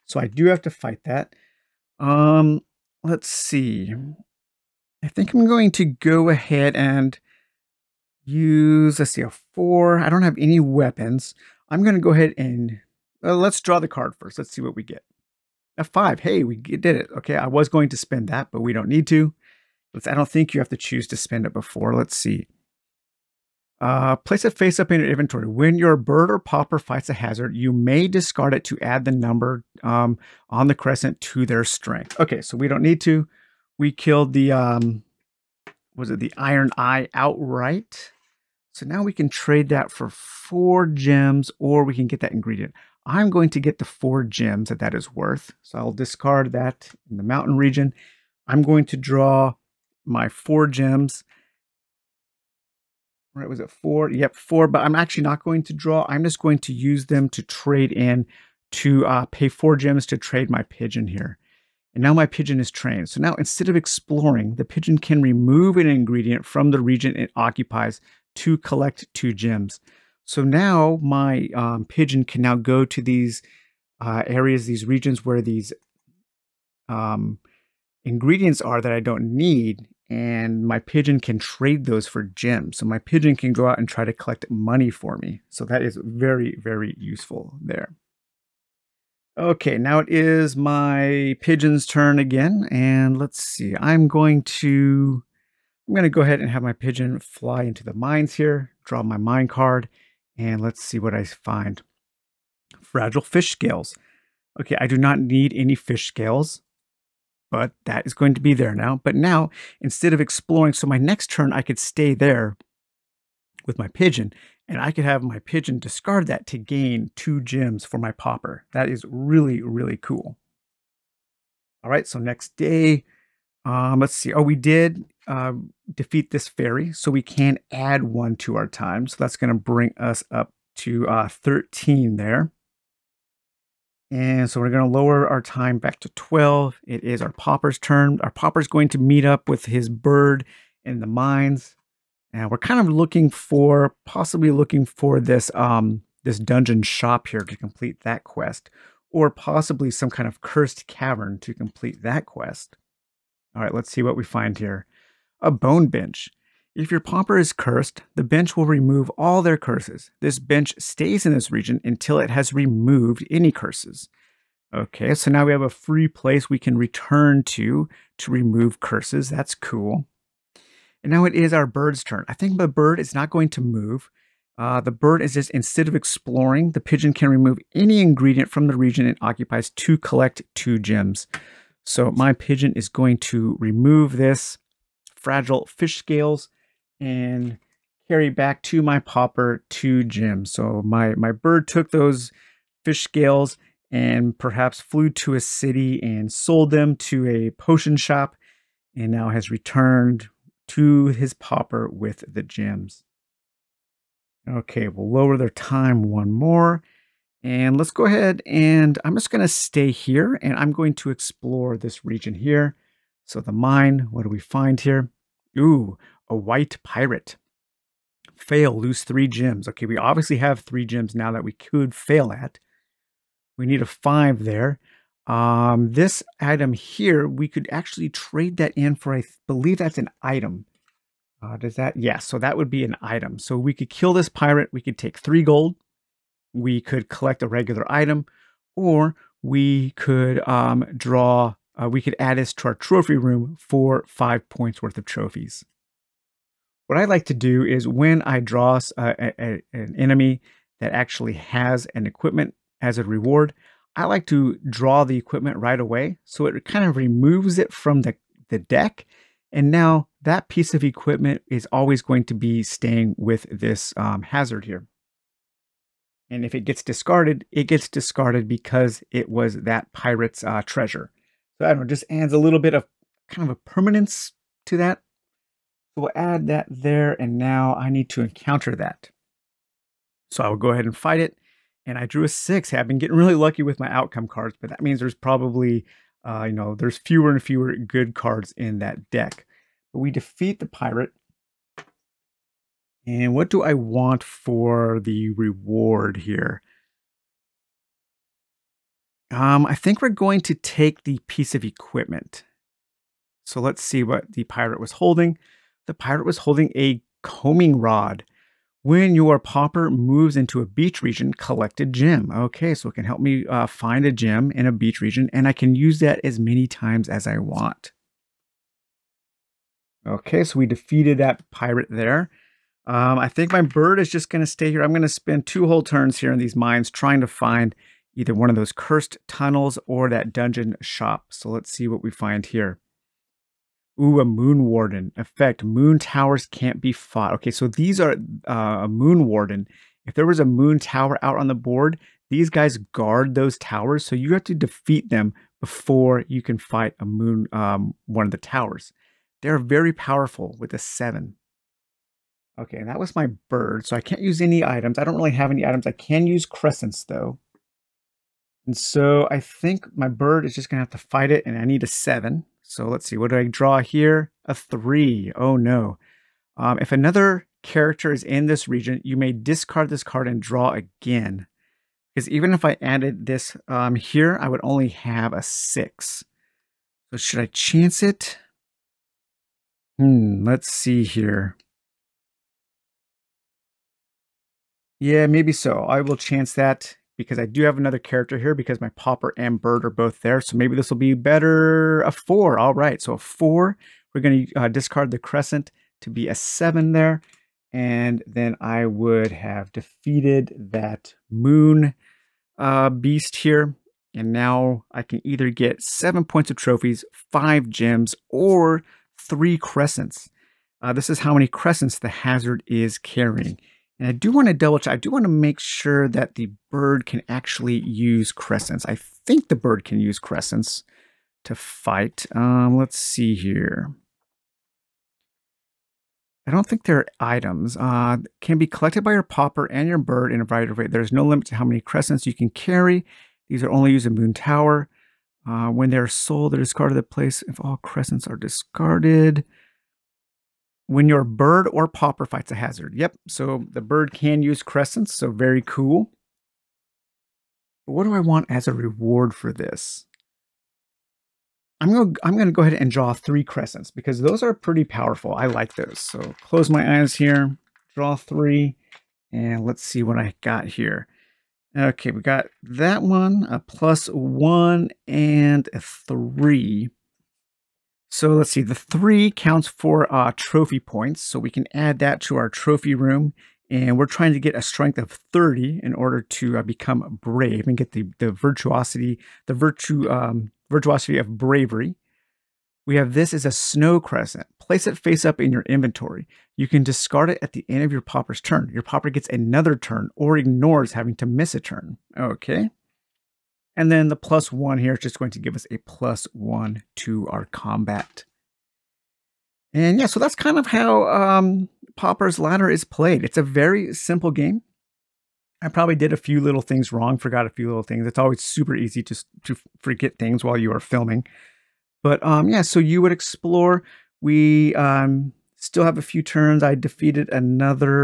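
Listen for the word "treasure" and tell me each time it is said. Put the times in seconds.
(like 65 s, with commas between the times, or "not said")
270 s.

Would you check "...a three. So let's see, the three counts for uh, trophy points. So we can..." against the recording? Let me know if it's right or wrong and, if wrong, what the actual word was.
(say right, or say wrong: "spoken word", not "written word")
right.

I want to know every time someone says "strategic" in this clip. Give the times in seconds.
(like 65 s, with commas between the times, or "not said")
not said.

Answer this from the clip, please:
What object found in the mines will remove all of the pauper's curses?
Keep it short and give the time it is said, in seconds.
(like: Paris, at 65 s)
A bone bench, at 155 s.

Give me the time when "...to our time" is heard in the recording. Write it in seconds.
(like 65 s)
128 s.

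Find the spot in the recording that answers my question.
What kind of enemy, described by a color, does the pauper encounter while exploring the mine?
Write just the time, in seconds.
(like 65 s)
216 s.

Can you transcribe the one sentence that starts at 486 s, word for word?
You can discard it at the end of your pauper's turn.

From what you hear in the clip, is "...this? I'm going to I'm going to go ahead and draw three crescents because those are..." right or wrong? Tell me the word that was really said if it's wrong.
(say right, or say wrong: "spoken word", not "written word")
right.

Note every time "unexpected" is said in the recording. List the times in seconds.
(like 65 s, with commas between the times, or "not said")
not said.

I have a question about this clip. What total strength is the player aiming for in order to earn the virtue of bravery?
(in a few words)
30.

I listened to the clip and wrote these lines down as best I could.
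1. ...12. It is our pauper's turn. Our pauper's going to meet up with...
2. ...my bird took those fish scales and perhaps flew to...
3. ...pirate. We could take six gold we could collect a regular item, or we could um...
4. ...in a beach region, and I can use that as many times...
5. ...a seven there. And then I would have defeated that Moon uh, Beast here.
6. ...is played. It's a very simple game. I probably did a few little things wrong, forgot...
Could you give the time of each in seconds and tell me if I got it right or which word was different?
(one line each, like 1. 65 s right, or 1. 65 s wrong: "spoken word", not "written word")
1. 136 s right
2. 191 s right
3. 234 s wrong: "three", not "six"
4. 314 s right
5. 396 s right
6. 502 s right.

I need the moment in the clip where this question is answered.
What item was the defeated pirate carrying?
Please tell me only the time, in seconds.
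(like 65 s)
307 s.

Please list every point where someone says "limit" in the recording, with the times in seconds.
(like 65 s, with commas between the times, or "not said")
431 s.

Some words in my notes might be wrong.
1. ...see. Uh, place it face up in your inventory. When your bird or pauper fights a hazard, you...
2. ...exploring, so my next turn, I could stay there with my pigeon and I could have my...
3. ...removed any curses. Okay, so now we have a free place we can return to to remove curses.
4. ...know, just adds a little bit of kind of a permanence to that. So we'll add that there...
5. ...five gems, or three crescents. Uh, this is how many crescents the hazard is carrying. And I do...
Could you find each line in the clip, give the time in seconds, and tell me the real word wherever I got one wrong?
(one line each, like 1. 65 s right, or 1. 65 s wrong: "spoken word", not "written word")
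1. 22 s right
2. 110 s right
3. 162 s right
4. 271 s right
5. 407 s right.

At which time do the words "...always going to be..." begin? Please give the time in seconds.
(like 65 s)
261 s.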